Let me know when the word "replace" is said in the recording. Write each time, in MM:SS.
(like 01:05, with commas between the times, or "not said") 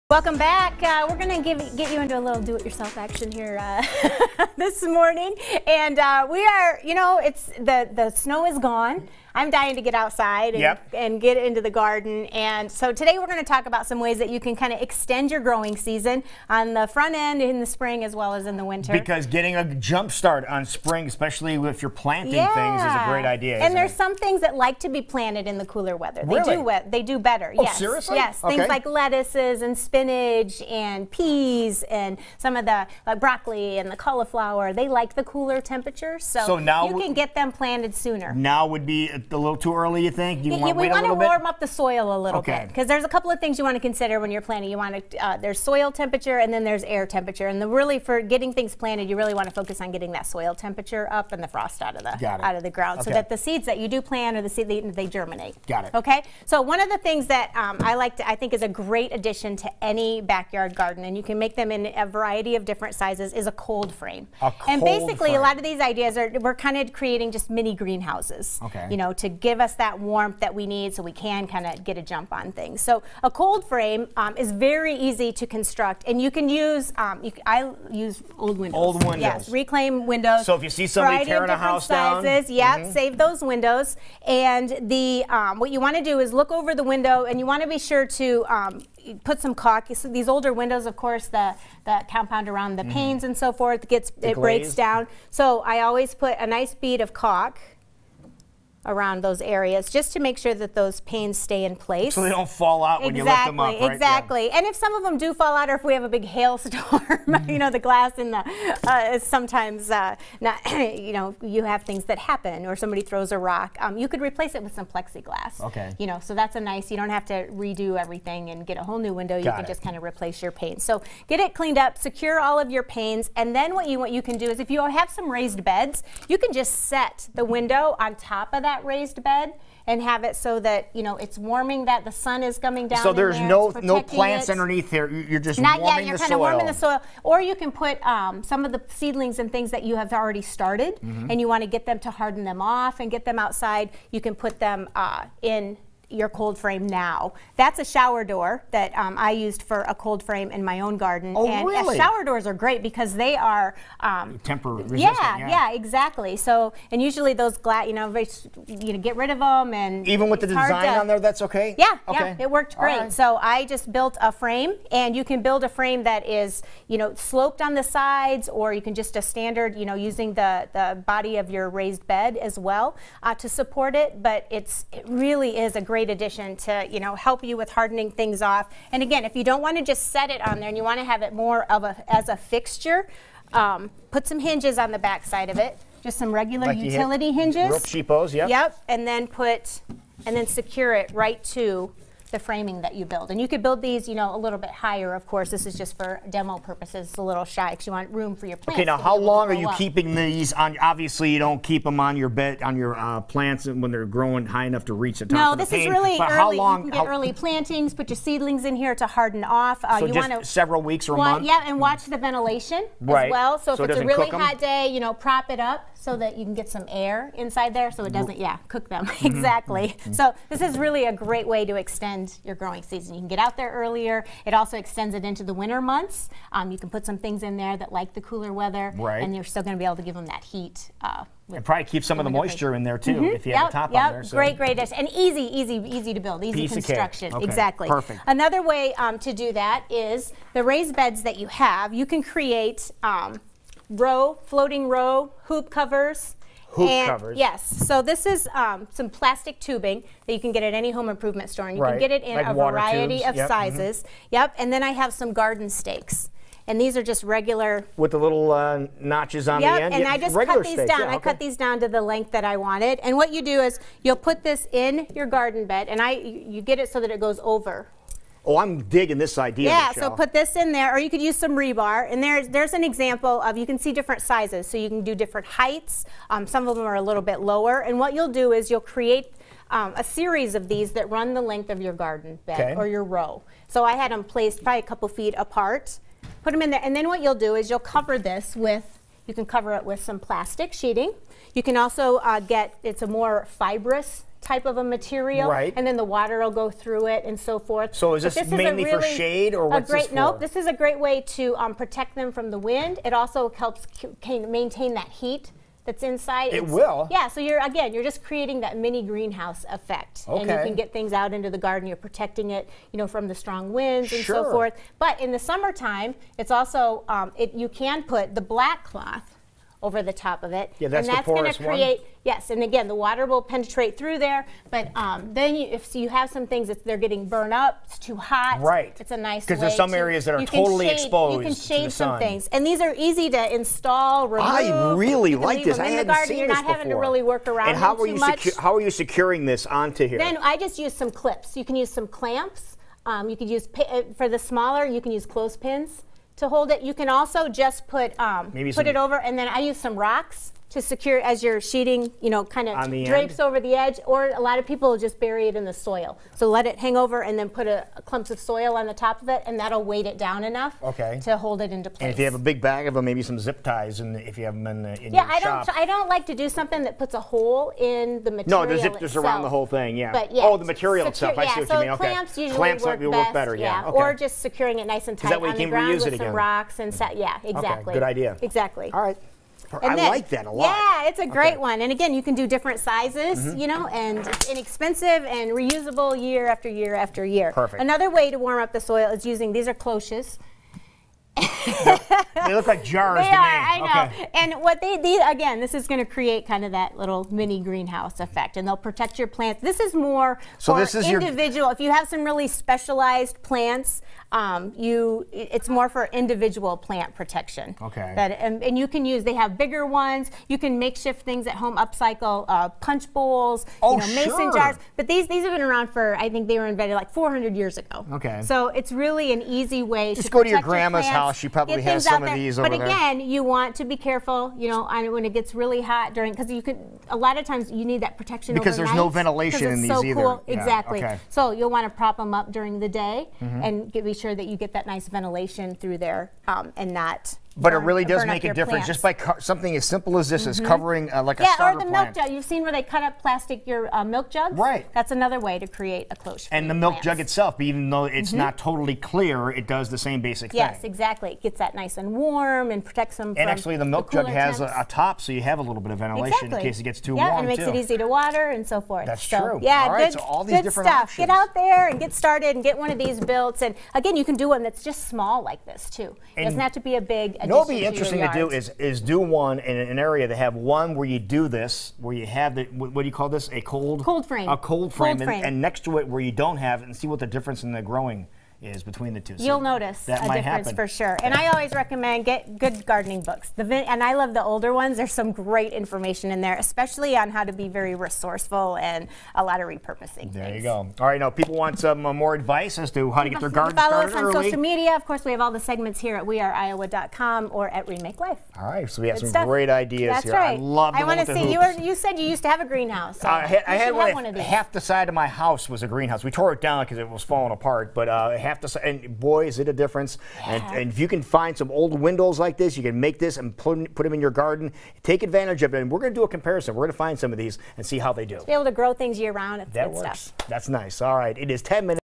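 01:54, 02:00.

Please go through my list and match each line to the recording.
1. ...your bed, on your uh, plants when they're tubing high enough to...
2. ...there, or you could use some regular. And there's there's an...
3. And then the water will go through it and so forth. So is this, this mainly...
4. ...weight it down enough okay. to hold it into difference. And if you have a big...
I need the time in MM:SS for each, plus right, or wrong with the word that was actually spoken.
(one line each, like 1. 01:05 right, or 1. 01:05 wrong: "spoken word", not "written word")
1. 03:22 wrong: "growing", not "tubing"
2. 04:30 wrong: "rebar", not "regular"
3. 04:55 right
4. 05:59 wrong: "place", not "difference".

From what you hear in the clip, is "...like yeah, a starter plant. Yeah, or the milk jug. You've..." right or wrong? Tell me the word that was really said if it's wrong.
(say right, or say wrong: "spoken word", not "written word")
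right.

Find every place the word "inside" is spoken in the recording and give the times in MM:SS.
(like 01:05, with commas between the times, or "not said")
03:37, 05:06.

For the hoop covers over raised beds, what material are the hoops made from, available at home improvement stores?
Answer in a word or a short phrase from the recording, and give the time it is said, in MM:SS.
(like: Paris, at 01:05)
Plastic tubing, at 04:09.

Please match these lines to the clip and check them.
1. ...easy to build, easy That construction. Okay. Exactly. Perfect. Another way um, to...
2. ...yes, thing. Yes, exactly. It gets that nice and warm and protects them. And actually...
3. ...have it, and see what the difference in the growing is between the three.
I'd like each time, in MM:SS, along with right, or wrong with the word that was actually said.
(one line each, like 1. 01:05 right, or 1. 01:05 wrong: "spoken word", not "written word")
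1. 03:55 wrong: "Piece", not "That"
2. 07:30 right
3. 07:56 wrong: "two", not "three".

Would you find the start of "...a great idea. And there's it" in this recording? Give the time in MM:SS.
00:23.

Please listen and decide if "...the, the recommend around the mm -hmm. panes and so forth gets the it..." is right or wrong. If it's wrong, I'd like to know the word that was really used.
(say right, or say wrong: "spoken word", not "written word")
wrong: "compound", not "recommend".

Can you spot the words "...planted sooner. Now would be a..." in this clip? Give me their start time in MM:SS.
00:37.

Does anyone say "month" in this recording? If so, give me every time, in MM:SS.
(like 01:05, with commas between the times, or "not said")
03:31, 03:45.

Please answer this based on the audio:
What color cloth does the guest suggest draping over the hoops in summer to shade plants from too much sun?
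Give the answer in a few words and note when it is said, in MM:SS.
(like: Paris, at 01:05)
Black, at 05:18.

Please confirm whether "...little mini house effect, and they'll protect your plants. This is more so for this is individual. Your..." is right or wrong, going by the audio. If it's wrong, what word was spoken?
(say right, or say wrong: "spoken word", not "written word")
wrong: "greenhouse", not "house".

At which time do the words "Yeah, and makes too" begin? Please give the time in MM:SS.
07:37.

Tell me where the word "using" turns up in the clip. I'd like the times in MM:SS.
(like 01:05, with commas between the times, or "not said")
02:49, 06:29.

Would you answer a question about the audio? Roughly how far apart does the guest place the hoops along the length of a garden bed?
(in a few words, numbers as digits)
A couple feet.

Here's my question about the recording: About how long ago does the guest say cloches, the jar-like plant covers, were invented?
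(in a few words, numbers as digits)
400 years ago.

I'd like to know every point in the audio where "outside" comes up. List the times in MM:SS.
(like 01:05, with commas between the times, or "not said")
00:09, 02:23.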